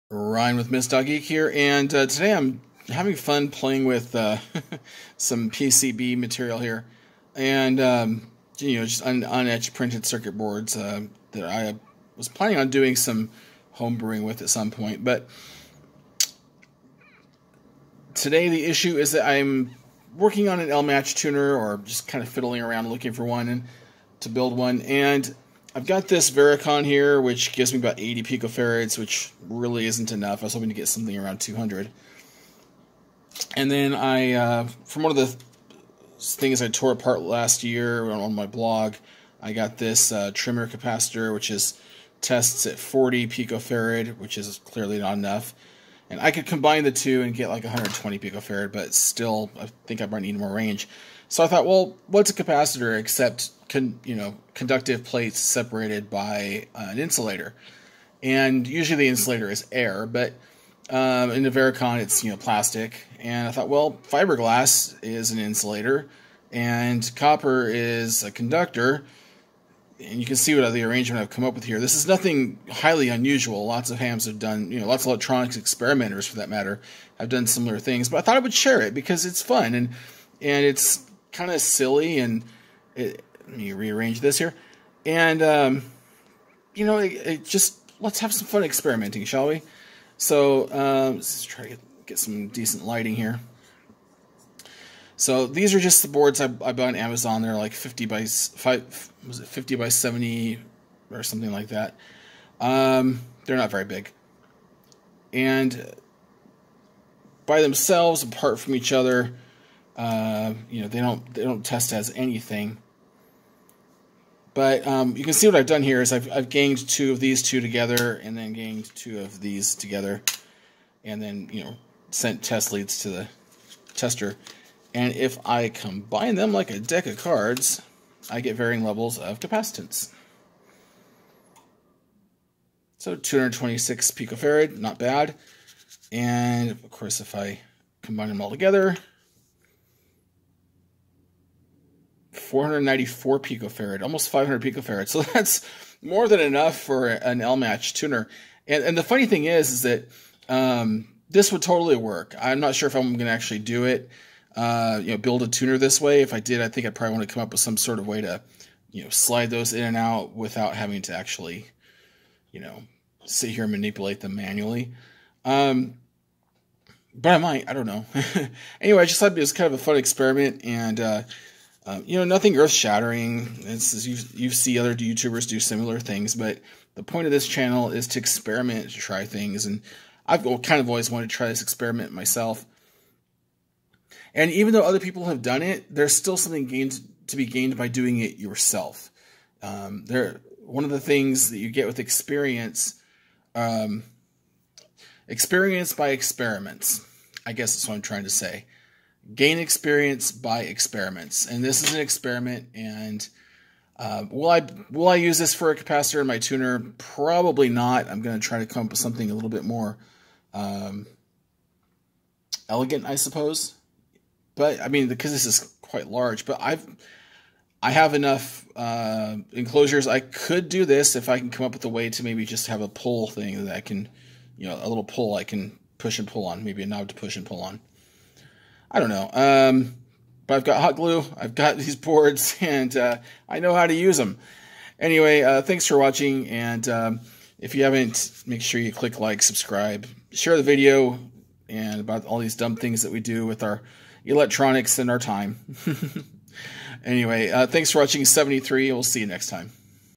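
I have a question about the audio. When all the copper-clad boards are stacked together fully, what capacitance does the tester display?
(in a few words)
494 picofarad.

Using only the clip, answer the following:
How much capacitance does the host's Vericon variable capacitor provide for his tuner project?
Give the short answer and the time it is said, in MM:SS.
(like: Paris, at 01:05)
80 picofarads, at 00:27.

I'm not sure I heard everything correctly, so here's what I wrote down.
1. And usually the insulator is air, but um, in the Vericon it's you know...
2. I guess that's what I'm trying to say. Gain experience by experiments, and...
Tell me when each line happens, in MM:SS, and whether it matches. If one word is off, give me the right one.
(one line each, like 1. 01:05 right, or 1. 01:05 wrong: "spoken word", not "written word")
1. 00:58 right
2. 03:17 right.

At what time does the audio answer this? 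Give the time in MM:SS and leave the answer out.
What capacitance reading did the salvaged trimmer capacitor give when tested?
00:42.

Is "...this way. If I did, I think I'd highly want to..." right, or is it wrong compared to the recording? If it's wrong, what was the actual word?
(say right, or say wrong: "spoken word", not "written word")
wrong: "probably", not "highly".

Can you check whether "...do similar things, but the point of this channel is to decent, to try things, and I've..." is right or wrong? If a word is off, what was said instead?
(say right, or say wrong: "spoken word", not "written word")
wrong: "experiment", not "decent".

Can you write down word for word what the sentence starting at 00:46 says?
And I could combine the two and get like 120 picofarad, but still, I think I might need more range.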